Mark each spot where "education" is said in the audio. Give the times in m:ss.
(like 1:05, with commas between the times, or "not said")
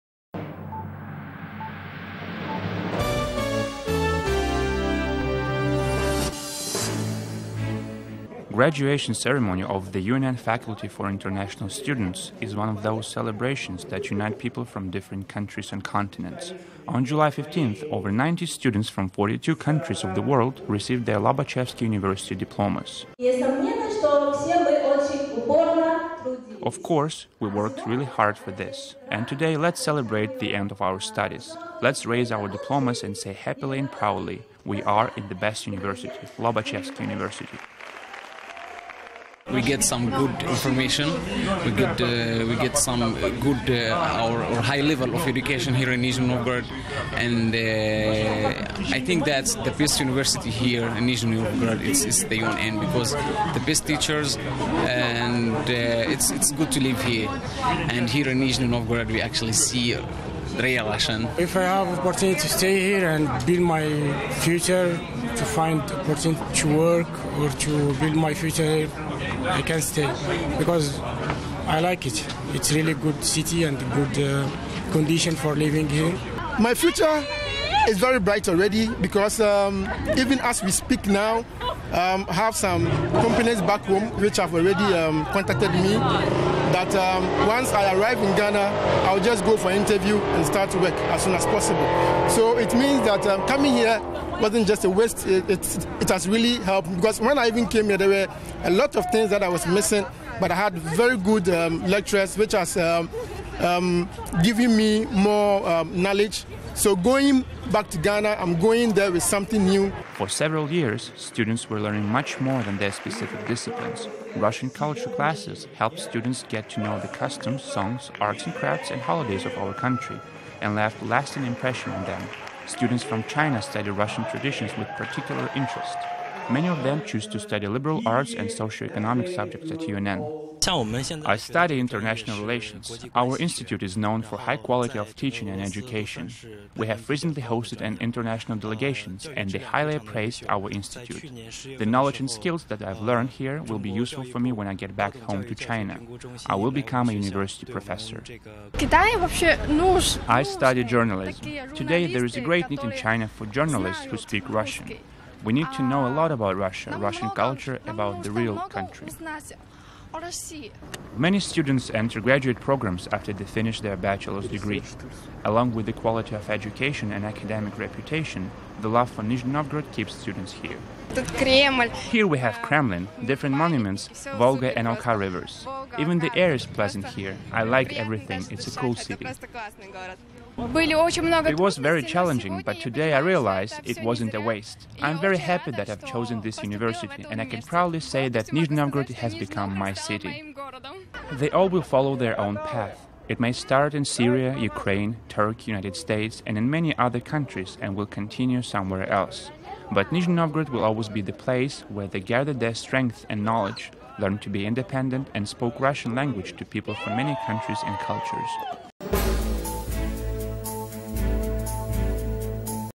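0:45, 2:15, 2:46.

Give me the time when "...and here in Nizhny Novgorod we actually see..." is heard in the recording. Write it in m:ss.
0:57.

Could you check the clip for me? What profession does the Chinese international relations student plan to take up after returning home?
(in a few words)
University professor.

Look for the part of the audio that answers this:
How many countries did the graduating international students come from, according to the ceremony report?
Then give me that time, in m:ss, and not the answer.
0:19.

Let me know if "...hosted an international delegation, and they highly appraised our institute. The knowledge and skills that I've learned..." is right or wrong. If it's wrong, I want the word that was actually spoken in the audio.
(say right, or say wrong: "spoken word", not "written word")
right.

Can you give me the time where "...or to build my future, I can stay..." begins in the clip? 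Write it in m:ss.
1:07.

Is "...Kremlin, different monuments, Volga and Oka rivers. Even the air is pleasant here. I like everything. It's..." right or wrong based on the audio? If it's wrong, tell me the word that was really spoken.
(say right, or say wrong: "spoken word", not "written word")
right.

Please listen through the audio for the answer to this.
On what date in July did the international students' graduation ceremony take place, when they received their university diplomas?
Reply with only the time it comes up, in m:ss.
0:17.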